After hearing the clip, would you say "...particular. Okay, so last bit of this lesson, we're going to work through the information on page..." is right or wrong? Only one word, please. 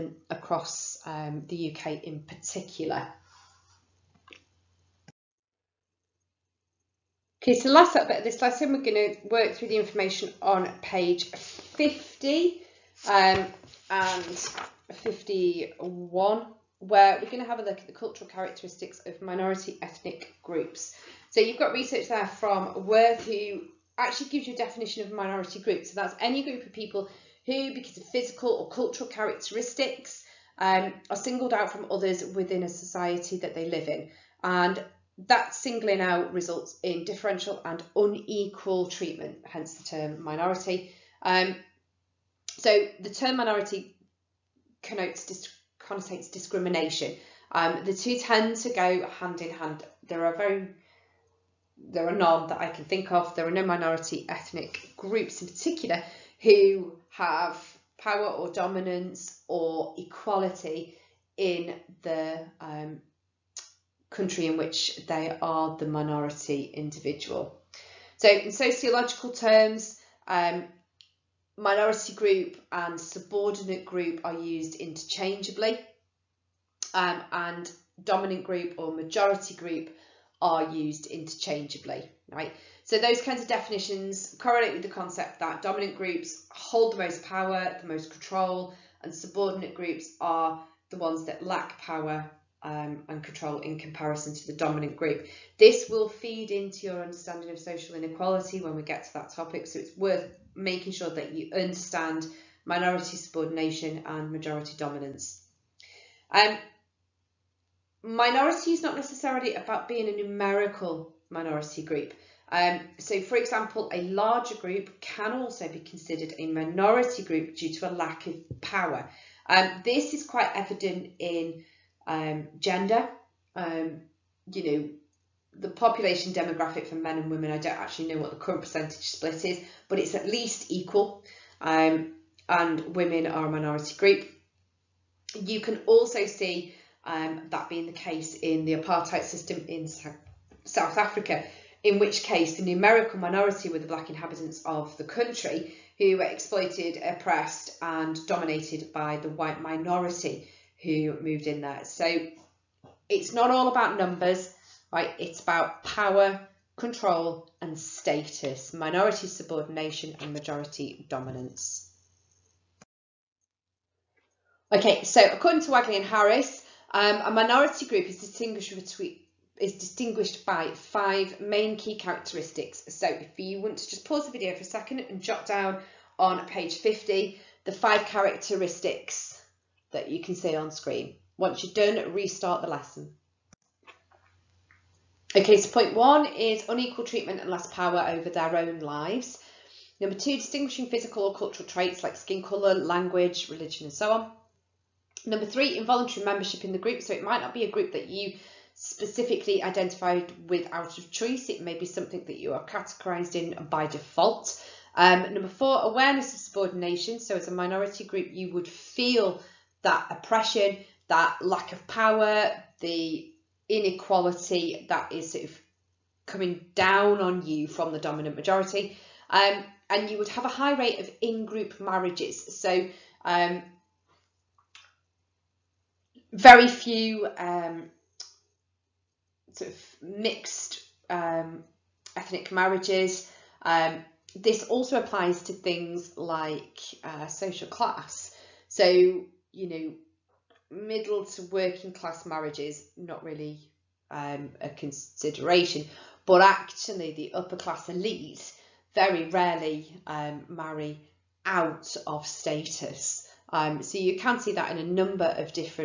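right.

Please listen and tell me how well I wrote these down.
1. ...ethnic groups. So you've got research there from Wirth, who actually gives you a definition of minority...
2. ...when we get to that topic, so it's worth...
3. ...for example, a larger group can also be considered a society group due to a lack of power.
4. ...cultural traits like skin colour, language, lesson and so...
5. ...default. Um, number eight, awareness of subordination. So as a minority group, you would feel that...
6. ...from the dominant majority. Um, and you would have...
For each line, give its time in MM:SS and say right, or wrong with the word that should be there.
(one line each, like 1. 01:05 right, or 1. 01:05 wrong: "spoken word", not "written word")
1. 00:19 right
2. 01:38 right
3. 01:53 wrong: "minority", not "society"
4. 03:11 wrong: "religion", not "lesson"
5. 03:23 wrong: "four", not "eight"
6. 03:37 right.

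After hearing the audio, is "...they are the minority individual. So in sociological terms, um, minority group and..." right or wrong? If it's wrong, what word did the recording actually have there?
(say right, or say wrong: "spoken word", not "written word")
right.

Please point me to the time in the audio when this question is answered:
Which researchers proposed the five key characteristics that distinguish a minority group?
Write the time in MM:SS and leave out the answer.
02:45.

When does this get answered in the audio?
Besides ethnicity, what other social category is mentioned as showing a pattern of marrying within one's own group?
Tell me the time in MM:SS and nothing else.
03:57.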